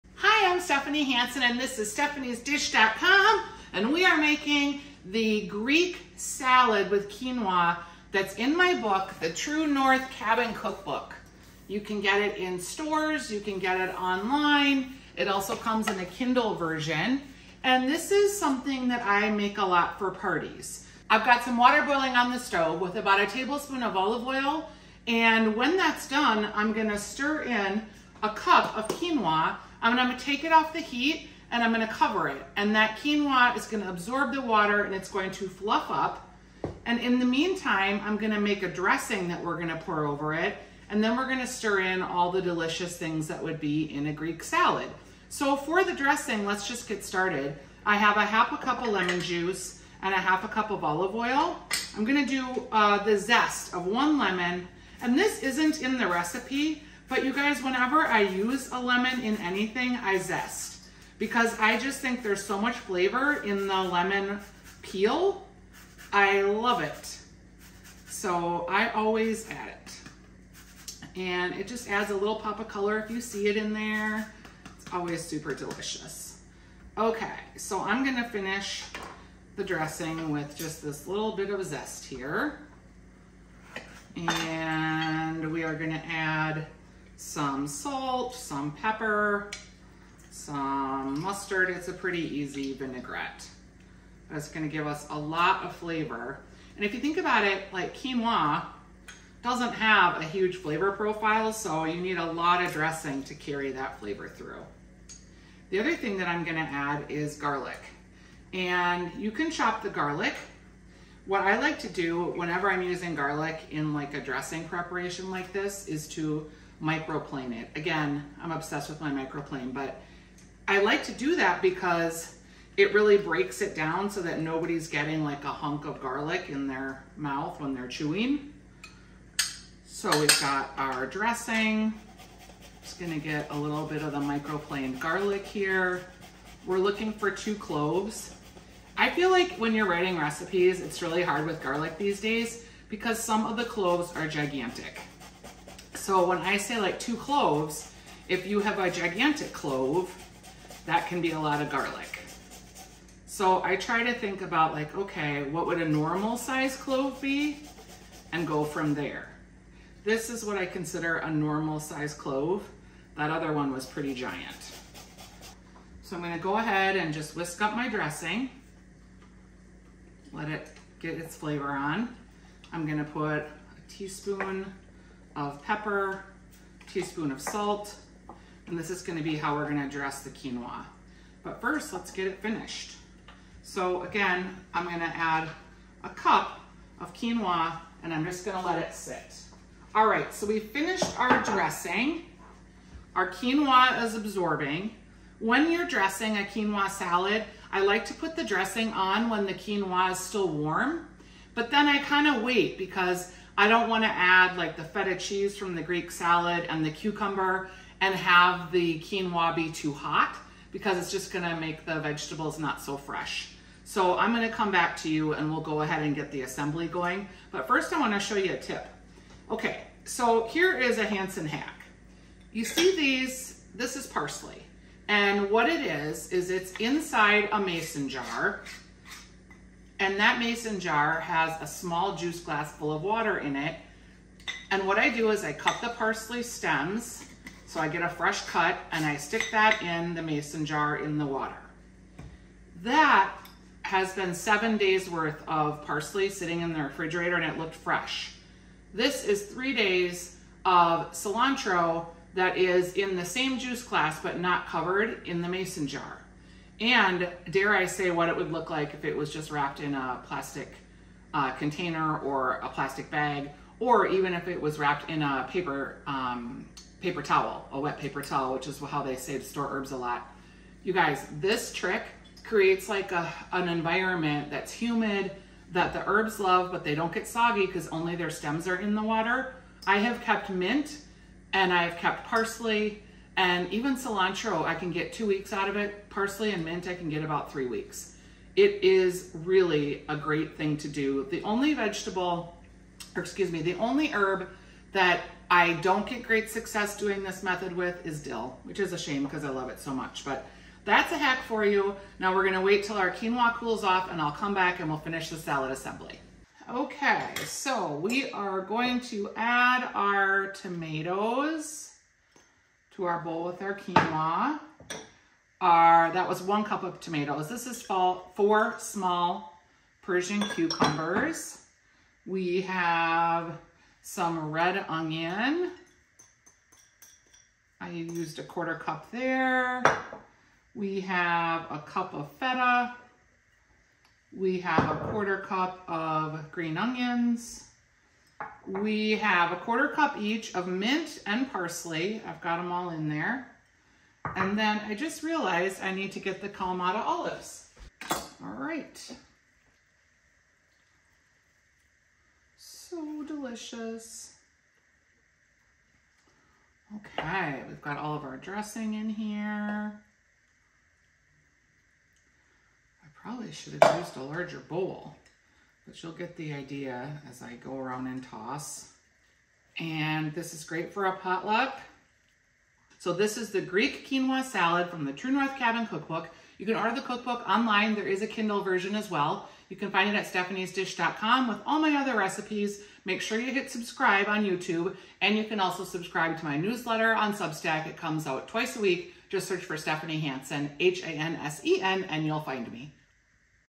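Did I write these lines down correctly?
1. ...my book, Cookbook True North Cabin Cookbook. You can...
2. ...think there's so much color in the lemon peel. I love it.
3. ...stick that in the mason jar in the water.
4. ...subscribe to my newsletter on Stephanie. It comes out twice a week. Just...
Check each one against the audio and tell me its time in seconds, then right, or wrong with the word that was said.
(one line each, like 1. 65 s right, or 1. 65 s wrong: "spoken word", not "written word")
1. 8 s wrong: "The", not "Cookbook"
2. 61 s wrong: "flavor", not "color"
3. 239 s right
4. 385 s wrong: "Substack", not "Stephanie".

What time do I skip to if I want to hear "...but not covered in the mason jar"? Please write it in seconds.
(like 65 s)
254 s.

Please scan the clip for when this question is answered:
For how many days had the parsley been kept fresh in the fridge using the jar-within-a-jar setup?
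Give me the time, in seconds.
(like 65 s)
244 s.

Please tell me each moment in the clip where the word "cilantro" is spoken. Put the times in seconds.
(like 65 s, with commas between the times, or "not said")
251 s, 283 s.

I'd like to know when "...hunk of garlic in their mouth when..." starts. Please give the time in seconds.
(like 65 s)
125 s.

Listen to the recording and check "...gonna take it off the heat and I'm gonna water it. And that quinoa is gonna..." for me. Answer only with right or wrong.
wrong.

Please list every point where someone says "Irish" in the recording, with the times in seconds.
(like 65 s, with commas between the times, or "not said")
not said.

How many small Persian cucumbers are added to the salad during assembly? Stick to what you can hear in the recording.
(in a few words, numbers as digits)
4.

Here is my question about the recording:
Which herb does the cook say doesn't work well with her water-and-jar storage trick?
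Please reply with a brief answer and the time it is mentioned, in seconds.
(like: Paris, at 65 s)
dill, at 298 s.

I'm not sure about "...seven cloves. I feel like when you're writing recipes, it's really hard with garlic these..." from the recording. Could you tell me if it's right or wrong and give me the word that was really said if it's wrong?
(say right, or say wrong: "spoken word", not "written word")
wrong: "two", not "seven".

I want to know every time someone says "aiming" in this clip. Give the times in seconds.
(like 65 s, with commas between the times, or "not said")
not said.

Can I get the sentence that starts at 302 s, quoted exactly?
Now we're gonna wait till our quinoa cools off and I'll come back and we'll finish the salad assembly.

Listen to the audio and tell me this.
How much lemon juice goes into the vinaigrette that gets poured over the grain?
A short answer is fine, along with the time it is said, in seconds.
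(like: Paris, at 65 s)
1/2 cup, at 48 s.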